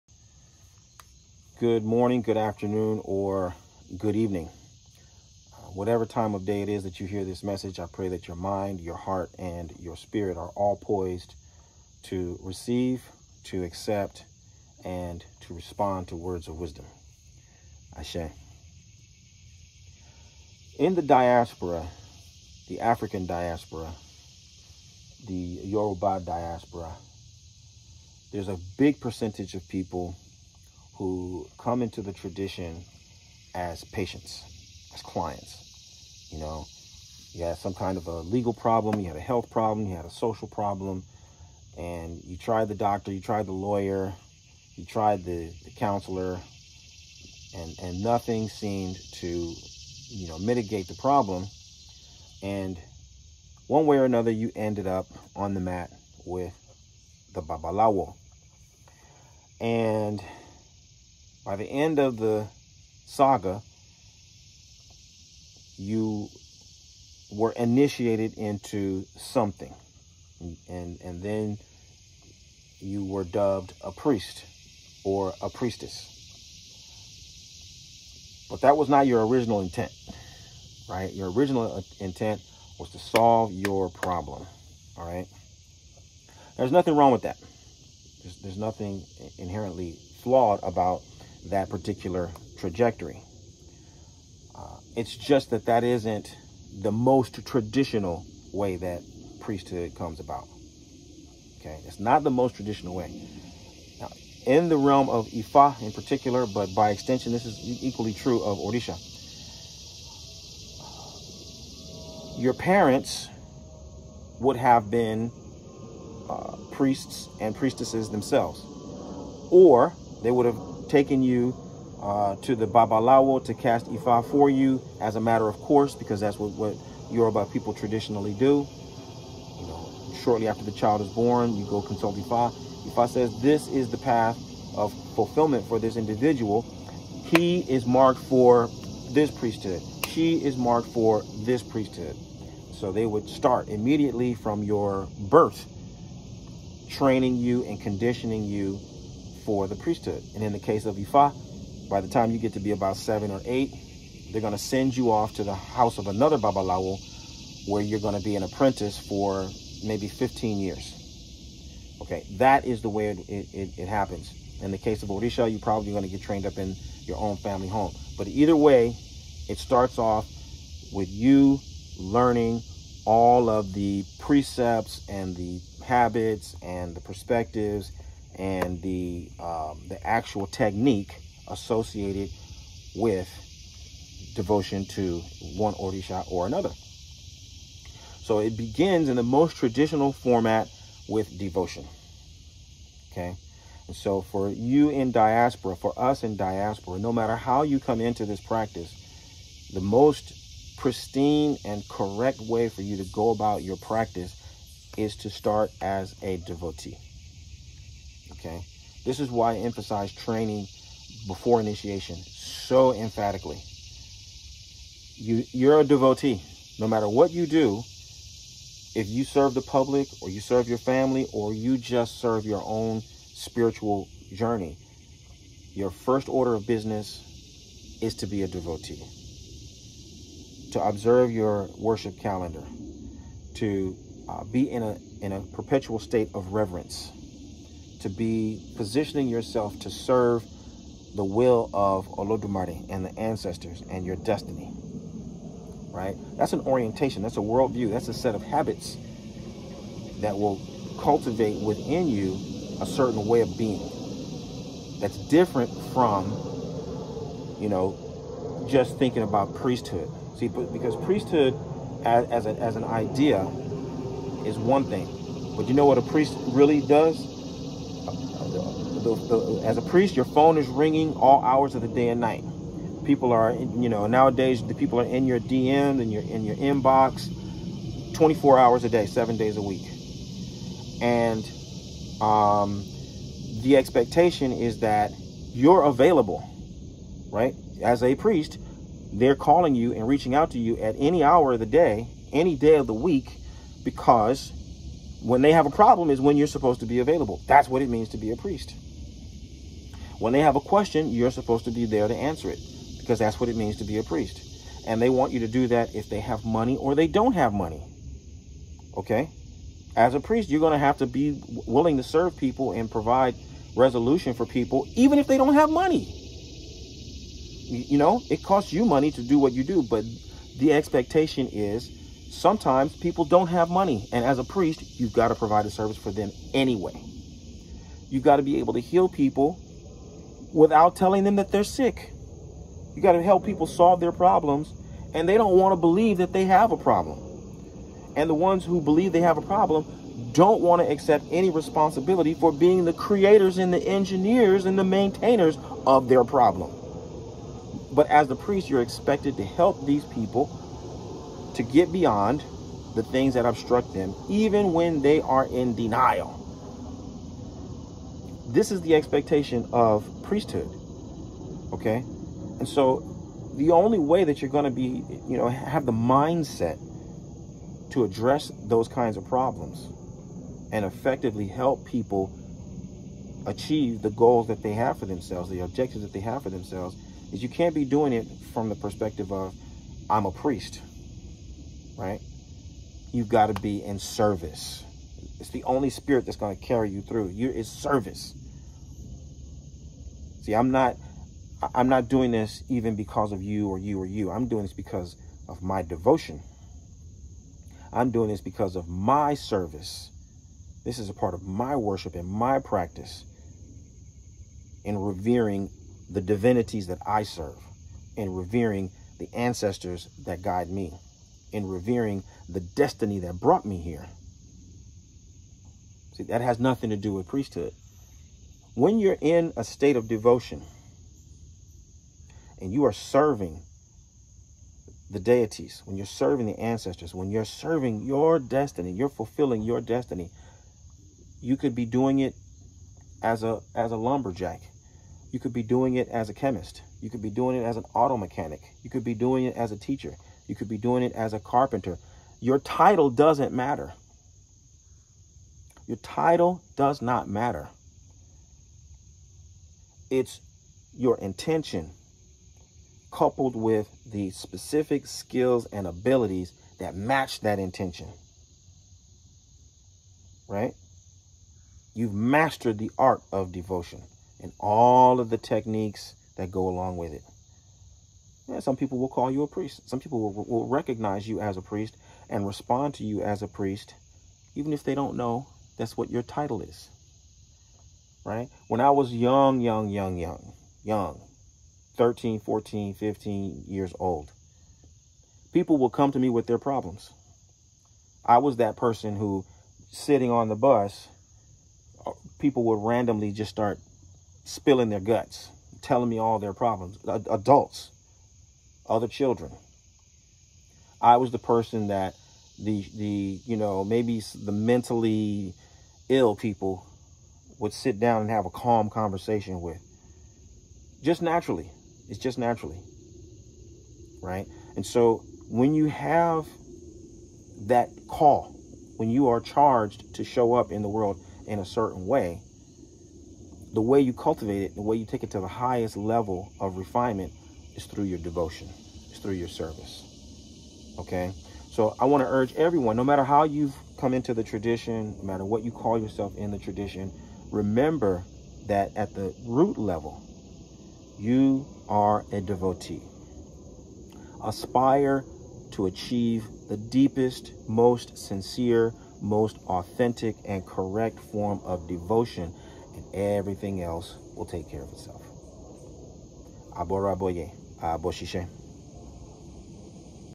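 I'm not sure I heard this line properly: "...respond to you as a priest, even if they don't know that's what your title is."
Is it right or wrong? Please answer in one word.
right.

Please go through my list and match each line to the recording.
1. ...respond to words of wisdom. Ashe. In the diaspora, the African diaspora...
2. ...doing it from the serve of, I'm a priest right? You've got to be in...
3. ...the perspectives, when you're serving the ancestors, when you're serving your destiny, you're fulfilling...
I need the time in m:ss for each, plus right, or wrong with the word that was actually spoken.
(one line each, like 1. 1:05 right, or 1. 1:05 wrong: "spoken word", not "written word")
1. 0:15 right
2. 6:17 wrong: "perspective", not "serve"
3. 7:05 wrong: "deities", not "perspectives".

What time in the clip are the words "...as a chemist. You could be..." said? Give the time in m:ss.
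7:16.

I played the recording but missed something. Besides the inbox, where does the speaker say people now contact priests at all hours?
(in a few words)
DMs.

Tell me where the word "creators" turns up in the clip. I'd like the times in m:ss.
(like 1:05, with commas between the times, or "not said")
5:42.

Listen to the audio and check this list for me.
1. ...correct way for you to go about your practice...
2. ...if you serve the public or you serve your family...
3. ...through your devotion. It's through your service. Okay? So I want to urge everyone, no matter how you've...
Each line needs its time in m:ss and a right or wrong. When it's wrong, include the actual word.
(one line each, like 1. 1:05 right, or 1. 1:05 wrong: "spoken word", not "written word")
1. 3:21 right
2. 3:38 right
3. 8:47 right.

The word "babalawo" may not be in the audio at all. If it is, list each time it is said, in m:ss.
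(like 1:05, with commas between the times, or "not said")
0:57, 2:02, 2:36.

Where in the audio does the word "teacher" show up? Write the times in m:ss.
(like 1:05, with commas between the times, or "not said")
7:19.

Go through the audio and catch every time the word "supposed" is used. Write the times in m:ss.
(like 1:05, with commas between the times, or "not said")
4:56, 5:01.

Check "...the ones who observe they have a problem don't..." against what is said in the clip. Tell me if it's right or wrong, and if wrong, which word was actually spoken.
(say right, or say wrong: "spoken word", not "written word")
wrong: "believe", not "observe".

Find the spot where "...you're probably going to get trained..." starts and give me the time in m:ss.
2:45.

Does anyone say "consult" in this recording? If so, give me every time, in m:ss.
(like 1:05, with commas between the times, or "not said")
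2:11.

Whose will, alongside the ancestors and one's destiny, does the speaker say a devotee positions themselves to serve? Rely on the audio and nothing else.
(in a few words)
Olodumare.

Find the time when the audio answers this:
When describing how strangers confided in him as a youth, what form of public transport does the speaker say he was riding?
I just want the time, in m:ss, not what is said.
8:10.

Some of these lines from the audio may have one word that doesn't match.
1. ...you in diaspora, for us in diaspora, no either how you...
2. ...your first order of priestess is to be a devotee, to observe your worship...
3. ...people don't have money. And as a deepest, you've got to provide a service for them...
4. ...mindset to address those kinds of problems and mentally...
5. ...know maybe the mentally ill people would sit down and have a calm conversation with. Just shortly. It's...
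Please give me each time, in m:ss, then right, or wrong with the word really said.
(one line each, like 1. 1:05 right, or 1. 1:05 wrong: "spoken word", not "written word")
1. 3:14 wrong: "matter", not "either"
2. 3:45 wrong: "business", not "priestess"
3. 5:22 wrong: "priest", not "deepest"
4. 6:05 wrong: "effectively", not "mentally"
5. 8:23 wrong: "naturally", not "shortly".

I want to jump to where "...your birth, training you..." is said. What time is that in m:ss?
2:24.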